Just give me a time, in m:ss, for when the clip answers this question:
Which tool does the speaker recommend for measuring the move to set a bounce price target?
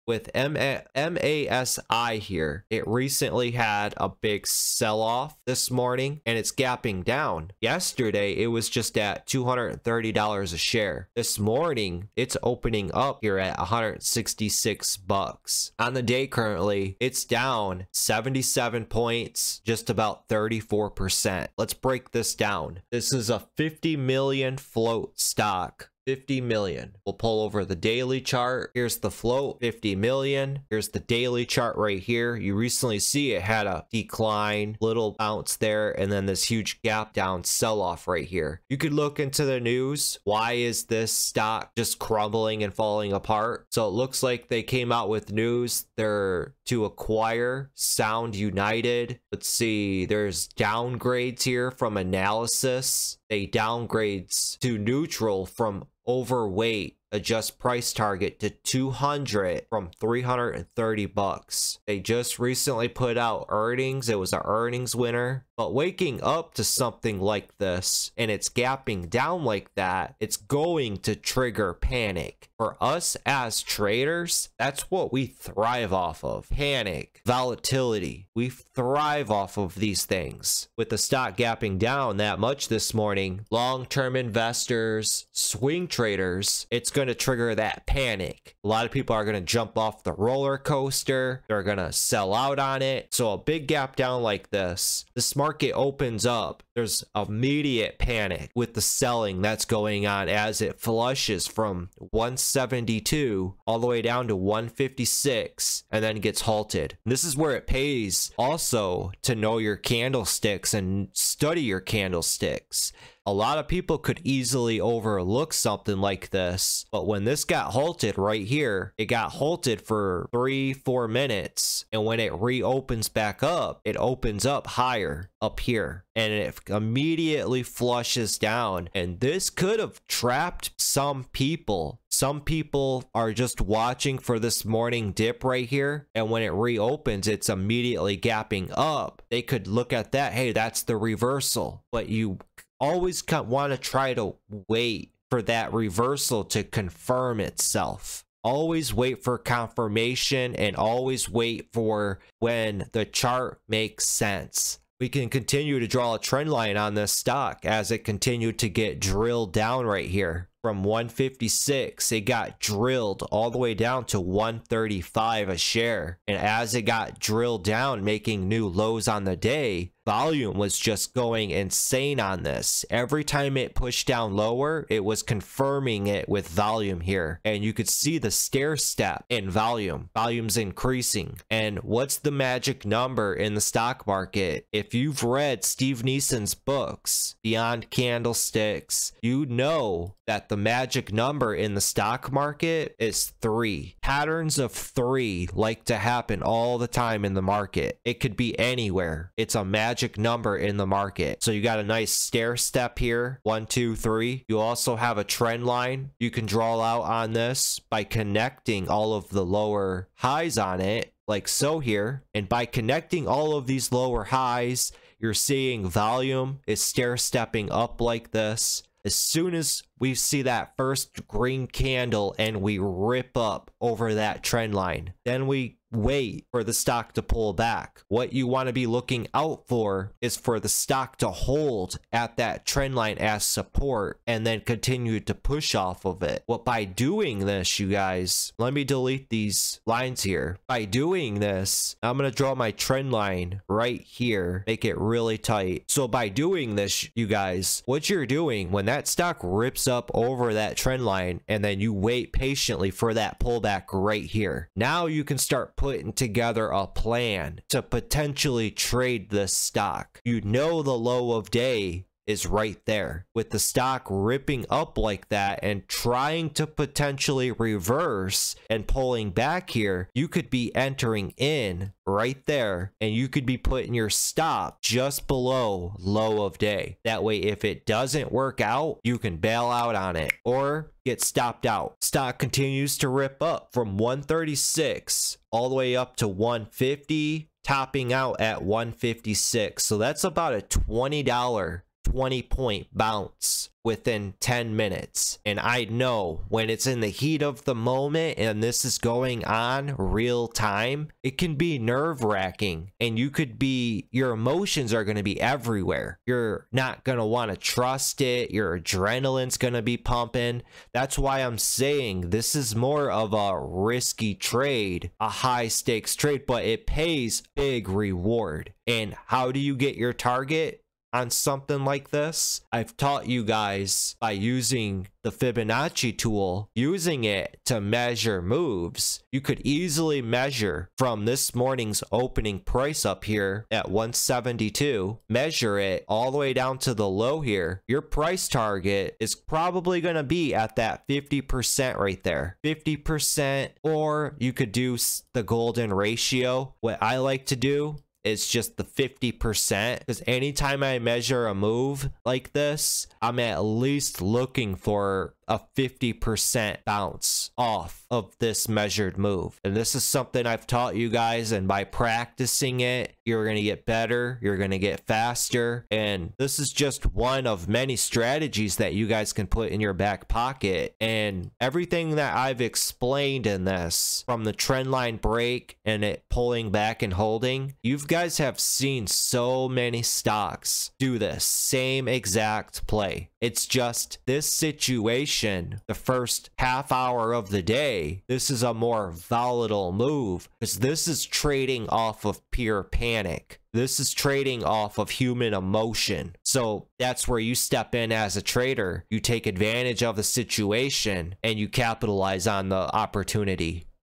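5:25.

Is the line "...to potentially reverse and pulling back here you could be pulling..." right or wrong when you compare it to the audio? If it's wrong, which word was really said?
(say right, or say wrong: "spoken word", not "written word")
wrong: "entering", not "pulling".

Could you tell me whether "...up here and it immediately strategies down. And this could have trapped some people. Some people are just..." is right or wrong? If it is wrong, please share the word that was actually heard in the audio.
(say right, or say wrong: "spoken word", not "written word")
wrong: "flushes", not "strategies".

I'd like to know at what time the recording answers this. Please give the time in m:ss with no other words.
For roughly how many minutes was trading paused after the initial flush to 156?
2:00.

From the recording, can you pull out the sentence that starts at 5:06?
You're not going to want to trust it.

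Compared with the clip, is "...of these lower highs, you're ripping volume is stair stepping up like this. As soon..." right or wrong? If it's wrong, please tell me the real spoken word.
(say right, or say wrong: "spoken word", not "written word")
wrong: "seeing", not "ripping".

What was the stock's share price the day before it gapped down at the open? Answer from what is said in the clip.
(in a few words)
$230.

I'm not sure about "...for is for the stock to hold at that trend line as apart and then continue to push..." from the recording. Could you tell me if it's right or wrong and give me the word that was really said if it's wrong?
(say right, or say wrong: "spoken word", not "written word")
wrong: "support", not "apart".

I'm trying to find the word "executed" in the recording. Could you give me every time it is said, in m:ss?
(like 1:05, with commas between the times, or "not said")
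not said.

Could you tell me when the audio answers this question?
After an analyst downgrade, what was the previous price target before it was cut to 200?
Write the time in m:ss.
0:59.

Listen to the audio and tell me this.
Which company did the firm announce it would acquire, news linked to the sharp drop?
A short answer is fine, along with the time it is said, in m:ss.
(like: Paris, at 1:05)
Sound United, at 0:47.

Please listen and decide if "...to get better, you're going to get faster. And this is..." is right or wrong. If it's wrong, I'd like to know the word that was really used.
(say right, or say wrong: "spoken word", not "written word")
right.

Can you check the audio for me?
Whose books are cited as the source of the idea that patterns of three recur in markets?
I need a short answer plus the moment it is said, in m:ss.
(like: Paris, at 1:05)
Steve Nison, at 3:05.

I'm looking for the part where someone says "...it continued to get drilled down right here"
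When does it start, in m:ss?
2:37.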